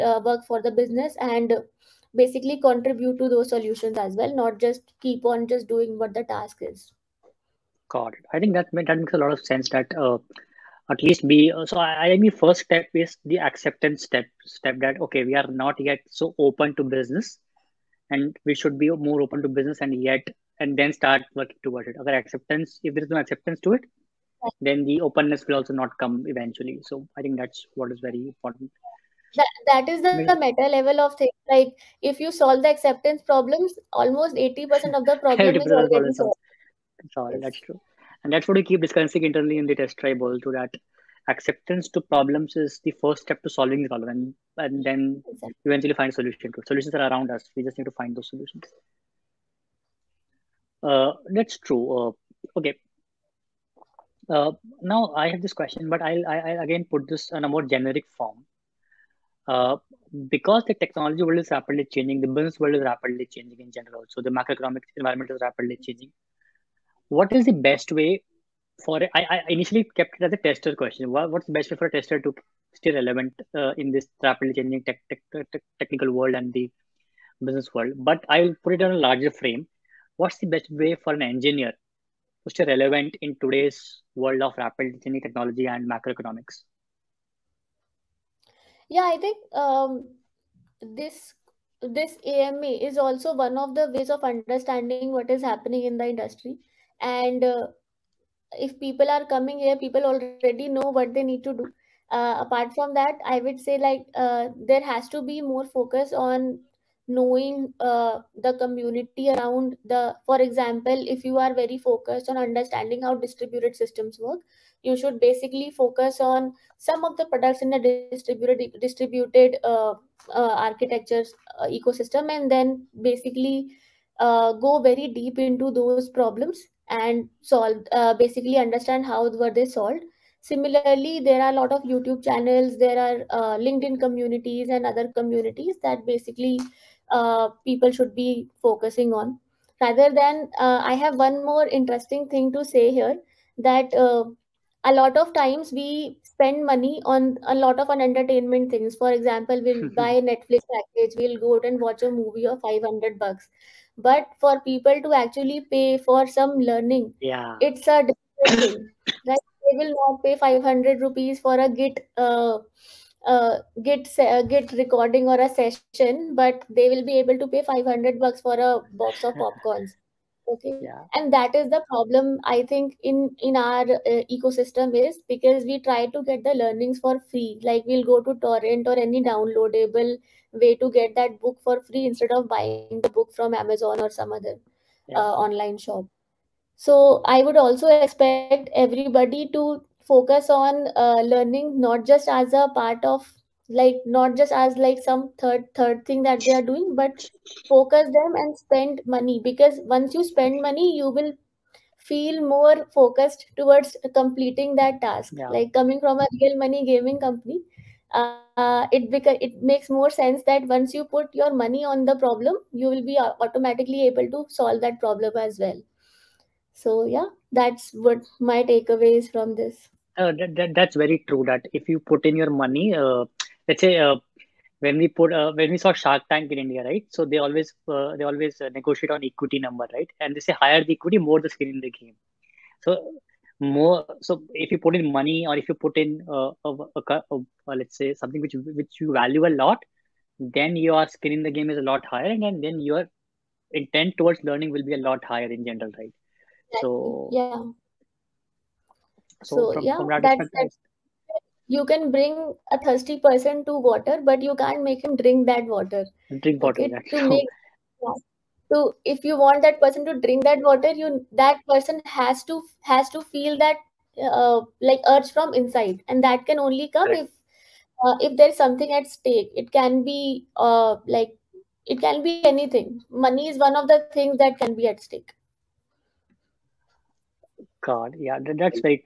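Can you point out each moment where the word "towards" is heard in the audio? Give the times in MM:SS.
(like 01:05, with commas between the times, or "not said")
00:21, 03:23, 04:04.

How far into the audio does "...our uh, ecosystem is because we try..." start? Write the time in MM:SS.
02:53.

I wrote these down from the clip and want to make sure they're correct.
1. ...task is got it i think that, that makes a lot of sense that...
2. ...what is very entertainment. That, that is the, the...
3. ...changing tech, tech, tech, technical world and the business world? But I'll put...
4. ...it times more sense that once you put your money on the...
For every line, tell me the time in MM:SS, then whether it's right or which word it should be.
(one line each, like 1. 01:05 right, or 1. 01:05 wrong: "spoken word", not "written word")
1. 00:06 right
2. 00:27 wrong: "important", not "entertainment"
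3. 01:14 right
4. 03:29 wrong: "makes", not "times".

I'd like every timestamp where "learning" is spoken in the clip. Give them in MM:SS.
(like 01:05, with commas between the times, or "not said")
02:36, 02:56, 03:11, 04:04.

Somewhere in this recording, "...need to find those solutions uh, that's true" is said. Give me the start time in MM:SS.
00:47.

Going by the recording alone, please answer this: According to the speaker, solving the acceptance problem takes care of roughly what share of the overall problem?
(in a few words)
80%.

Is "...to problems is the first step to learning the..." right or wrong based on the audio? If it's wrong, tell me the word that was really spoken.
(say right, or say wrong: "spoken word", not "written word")
wrong: "solving", not "learning".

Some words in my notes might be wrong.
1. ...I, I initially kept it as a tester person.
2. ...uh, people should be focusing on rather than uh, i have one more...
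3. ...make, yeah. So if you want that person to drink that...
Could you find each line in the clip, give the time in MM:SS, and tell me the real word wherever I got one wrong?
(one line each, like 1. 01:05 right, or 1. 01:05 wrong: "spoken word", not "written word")
1. 01:09 wrong: "question", not "person"
2. 02:17 right
3. 04:17 right.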